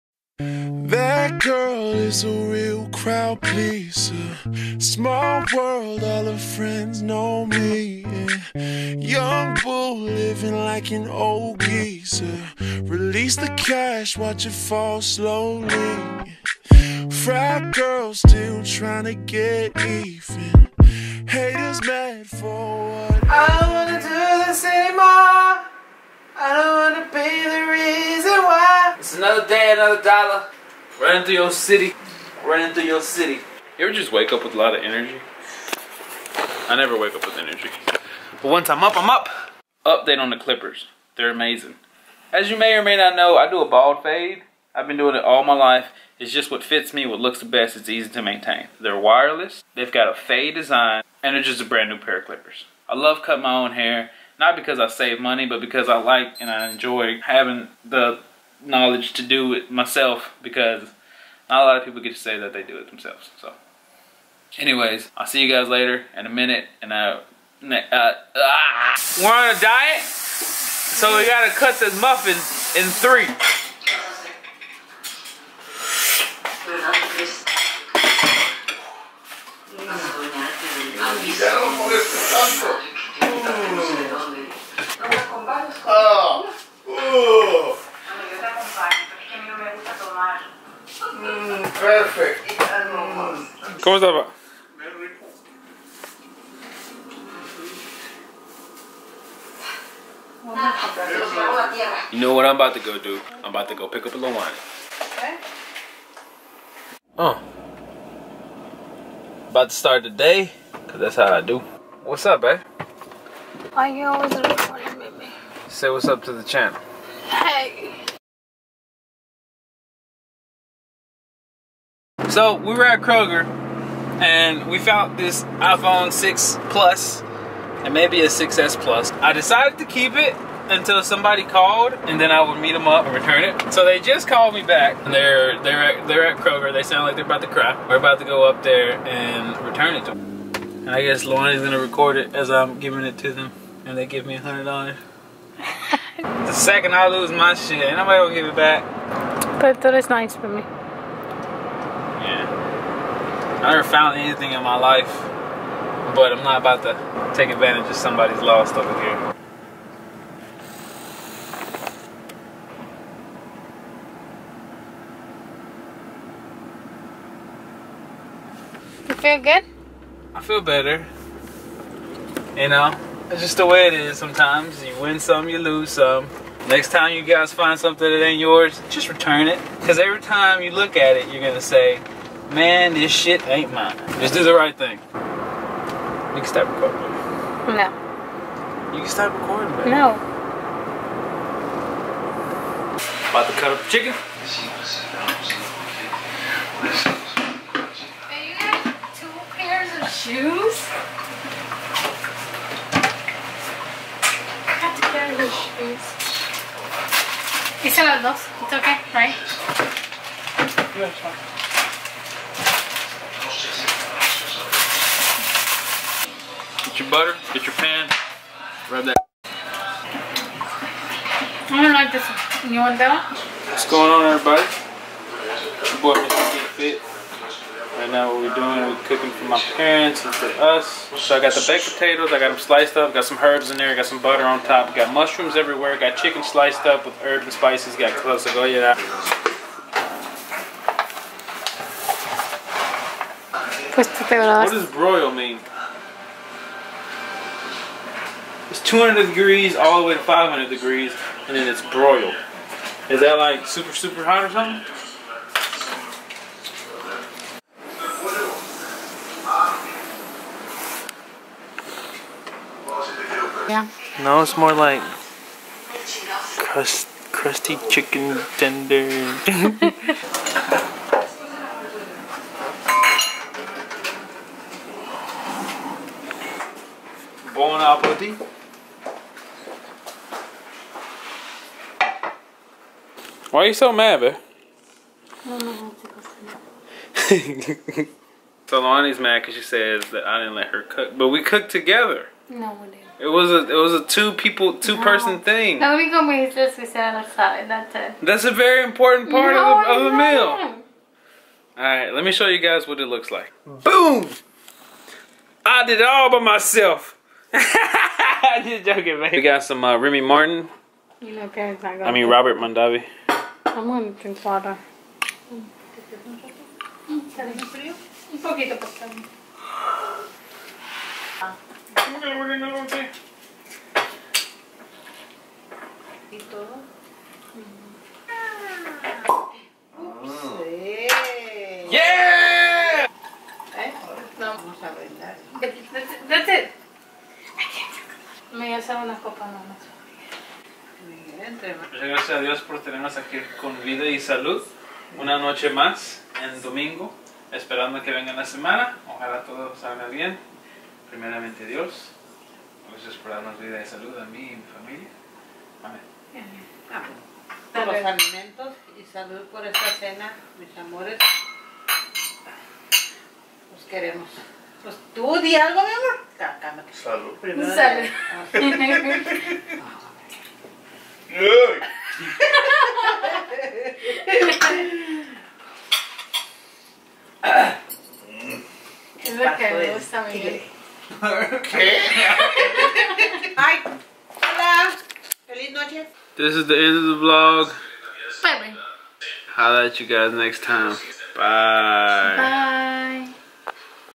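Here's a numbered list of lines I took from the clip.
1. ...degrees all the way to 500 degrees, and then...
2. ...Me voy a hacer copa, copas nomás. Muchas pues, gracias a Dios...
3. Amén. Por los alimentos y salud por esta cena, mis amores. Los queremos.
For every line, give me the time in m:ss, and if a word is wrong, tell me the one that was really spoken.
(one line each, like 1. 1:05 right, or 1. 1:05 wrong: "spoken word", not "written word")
1. 4:09 right
2. 5:38 right
3. 5:55 right.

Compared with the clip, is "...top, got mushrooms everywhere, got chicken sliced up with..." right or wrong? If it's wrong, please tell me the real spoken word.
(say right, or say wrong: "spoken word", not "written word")
right.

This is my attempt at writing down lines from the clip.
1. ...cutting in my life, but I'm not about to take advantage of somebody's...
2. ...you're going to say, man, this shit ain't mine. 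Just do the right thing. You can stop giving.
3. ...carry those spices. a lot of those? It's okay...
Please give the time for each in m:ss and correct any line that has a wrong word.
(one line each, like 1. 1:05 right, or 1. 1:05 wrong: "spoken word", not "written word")
1. 2:34 wrong: "anything", not "cutting"
2. 3:01 wrong: "recording", not "giving"
3. 3:25 wrong: "shoes", not "spices".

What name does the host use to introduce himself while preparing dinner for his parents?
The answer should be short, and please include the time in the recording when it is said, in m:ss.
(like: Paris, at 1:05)
Mr. Get Fit, at 3:46.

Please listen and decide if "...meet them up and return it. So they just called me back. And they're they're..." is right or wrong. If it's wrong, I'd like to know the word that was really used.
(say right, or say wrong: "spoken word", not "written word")
right.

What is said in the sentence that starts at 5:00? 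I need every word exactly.
All right, let me show you guys what it looks like.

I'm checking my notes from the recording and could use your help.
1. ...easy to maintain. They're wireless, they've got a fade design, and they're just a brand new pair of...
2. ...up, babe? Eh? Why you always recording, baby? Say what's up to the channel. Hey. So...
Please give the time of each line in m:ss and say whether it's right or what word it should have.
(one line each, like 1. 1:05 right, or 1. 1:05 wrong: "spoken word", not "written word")
1. 0:47 right
2. 1:52 right.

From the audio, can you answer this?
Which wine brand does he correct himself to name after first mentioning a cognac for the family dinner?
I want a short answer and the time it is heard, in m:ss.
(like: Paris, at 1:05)
Robert Mondavi, at 5:12.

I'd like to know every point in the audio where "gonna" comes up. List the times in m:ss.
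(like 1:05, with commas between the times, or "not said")
2:21, 2:28.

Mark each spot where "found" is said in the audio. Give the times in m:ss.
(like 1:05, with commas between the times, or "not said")
2:04, 2:33.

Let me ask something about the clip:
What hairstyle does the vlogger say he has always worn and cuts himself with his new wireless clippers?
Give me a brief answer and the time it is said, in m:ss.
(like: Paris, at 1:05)
bald fade, at 0:43.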